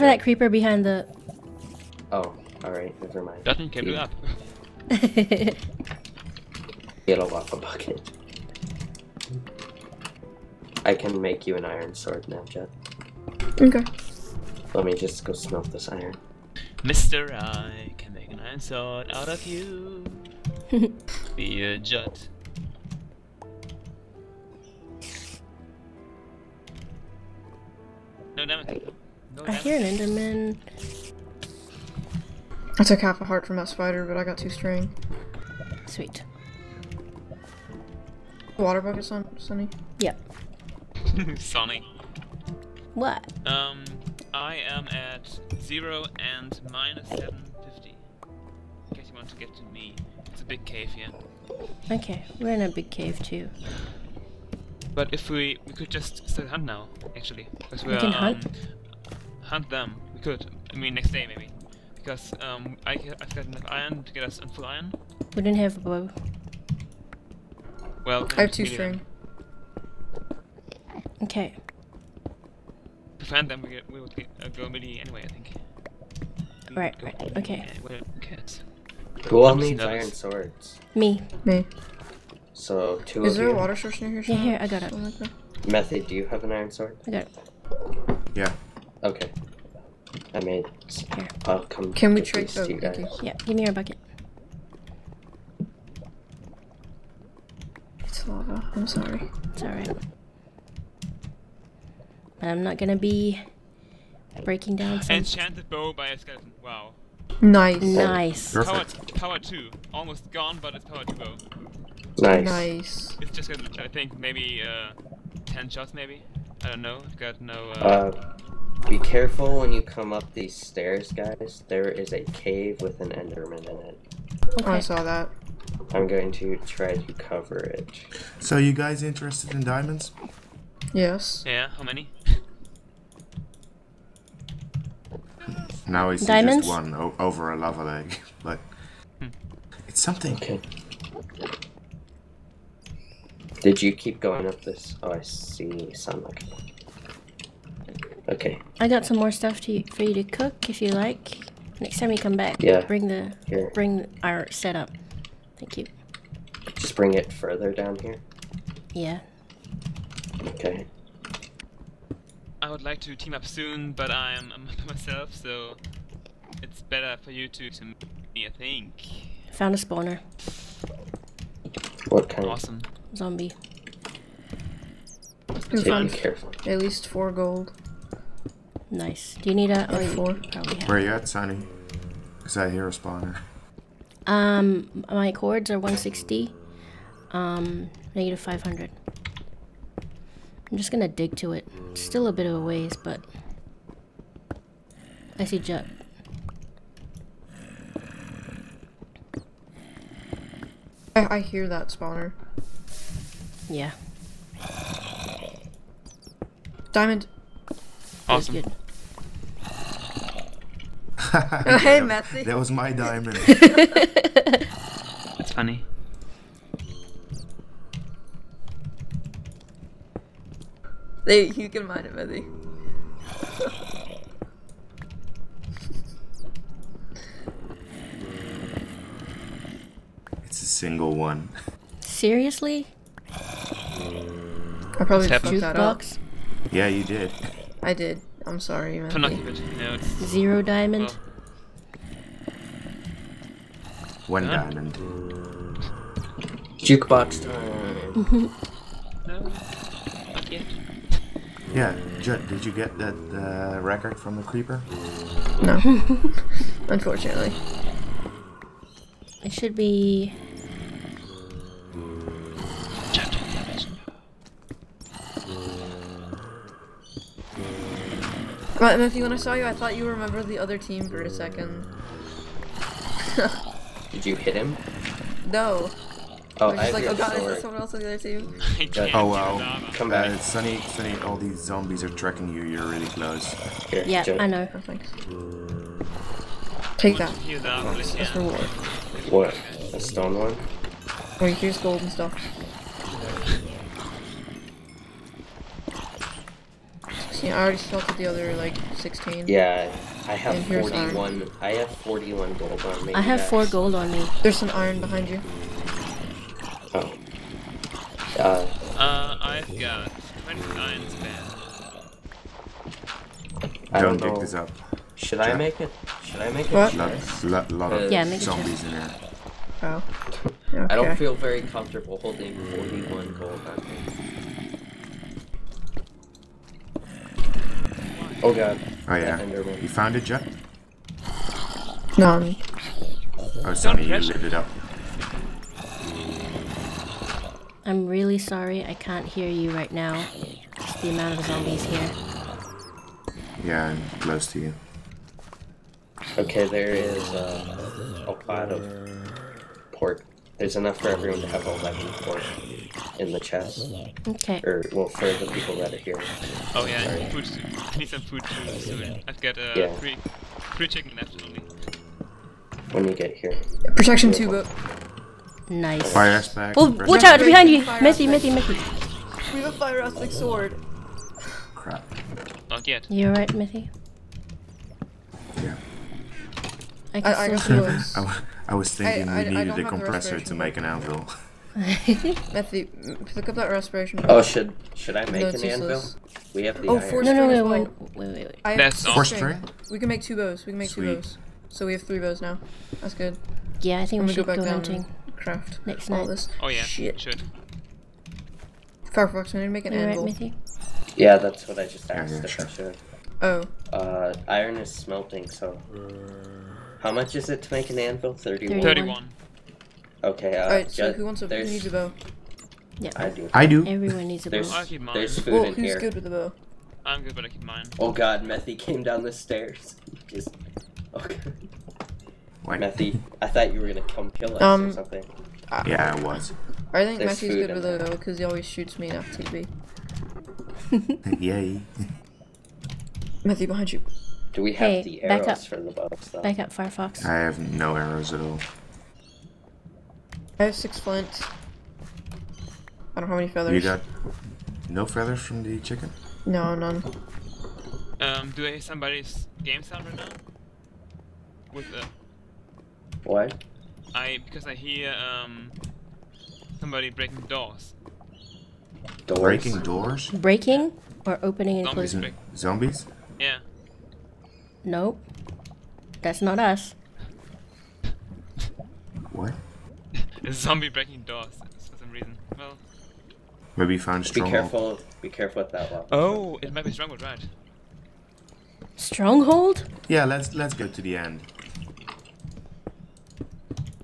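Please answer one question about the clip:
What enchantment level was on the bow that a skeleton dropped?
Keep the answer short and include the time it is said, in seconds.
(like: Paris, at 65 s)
Power 2, at 108 s.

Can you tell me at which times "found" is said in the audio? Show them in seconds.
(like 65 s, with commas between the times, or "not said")
169 s, 329 s, 473 s.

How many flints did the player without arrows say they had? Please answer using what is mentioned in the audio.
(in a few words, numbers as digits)
6.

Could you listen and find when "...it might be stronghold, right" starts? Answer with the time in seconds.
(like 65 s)
476 s.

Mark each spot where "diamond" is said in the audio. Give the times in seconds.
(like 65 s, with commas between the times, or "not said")
129 s, 136 s, 206 s, 212 s, 240 s, 244 s.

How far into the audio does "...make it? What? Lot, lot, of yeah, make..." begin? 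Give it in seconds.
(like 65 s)
316 s.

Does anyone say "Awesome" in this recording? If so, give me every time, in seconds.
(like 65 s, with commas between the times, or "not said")
172 s, 208 s.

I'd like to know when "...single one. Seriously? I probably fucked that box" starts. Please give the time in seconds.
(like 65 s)
230 s.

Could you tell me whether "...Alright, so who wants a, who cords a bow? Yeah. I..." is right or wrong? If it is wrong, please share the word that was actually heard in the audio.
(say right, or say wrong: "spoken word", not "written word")
wrong: "needs", not "cords".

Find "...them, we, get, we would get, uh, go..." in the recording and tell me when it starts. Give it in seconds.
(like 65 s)
73 s.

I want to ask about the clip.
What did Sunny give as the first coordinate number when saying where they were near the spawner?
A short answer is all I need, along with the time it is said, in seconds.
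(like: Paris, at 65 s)
160, at 185 s.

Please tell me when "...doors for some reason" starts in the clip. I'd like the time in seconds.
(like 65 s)
471 s.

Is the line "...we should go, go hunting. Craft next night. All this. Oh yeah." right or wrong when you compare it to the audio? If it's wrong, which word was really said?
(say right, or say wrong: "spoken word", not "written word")
right.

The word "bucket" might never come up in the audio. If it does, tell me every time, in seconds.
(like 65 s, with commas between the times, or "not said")
7 s, 38 s, 93 s.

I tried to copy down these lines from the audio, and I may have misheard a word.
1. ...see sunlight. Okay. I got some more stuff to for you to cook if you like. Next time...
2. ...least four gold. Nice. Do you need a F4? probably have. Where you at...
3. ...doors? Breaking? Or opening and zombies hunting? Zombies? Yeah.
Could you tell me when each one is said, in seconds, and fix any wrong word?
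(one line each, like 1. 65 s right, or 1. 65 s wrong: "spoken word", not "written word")
1. 145 s right
2. 176 s right
3. 459 s wrong: "closing", not "hunting".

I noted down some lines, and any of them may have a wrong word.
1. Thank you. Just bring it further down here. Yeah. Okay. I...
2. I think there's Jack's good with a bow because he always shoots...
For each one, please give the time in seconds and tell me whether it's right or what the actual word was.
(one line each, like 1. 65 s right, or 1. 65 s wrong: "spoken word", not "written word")
1. 155 s right
2. 426 s wrong: "Methy", not "Jack".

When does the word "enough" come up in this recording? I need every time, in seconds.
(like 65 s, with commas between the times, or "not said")
63 s, 350 s.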